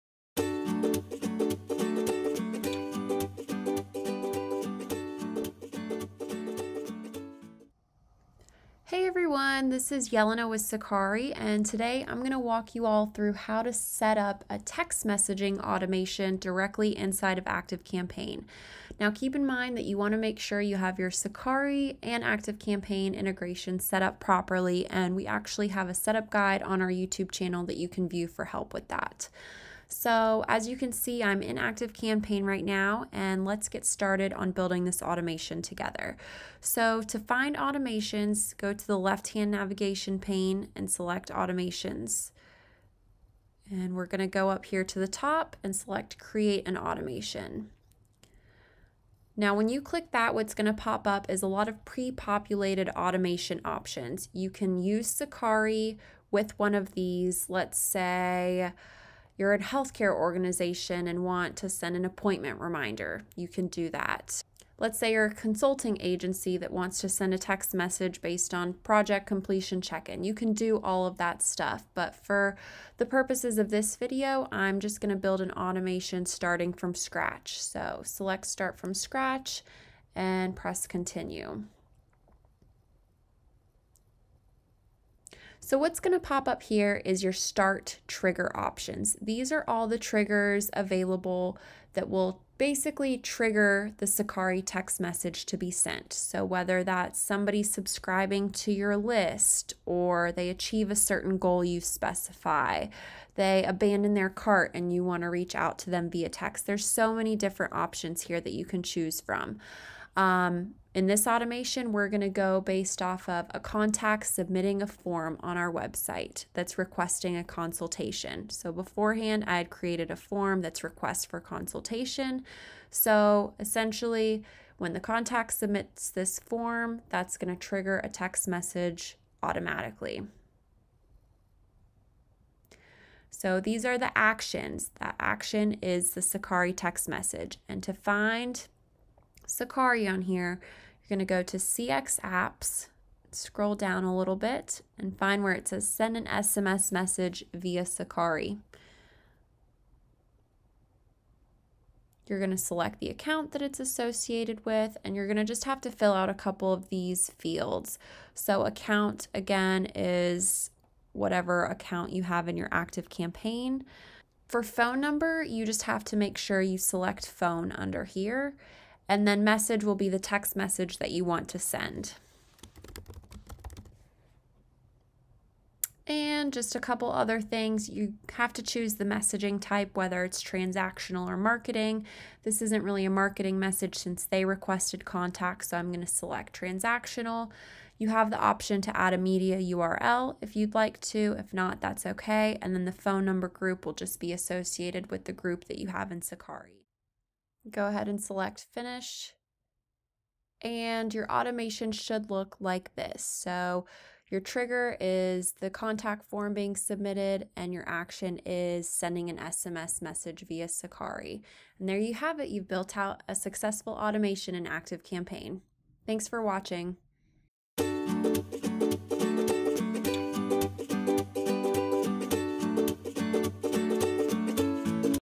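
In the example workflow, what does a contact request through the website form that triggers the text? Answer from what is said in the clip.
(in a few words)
a consultation.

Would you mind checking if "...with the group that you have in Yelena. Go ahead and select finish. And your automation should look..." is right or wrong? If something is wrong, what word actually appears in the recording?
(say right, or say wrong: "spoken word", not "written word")
wrong: "Sakari", not "Yelena".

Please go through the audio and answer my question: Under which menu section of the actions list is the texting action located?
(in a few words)
CX Apps.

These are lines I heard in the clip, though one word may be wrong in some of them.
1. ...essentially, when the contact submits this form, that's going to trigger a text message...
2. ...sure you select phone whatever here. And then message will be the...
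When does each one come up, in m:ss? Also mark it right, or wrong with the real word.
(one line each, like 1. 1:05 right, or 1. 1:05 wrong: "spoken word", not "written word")
1. 2:03 right
2. 2:46 wrong: "under", not "whatever".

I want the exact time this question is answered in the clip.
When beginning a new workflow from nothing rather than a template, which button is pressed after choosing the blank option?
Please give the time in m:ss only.
1:20.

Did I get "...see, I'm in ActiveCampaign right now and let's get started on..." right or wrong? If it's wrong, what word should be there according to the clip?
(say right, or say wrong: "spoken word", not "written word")
right.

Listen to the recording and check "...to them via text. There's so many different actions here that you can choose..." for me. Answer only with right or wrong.
wrong.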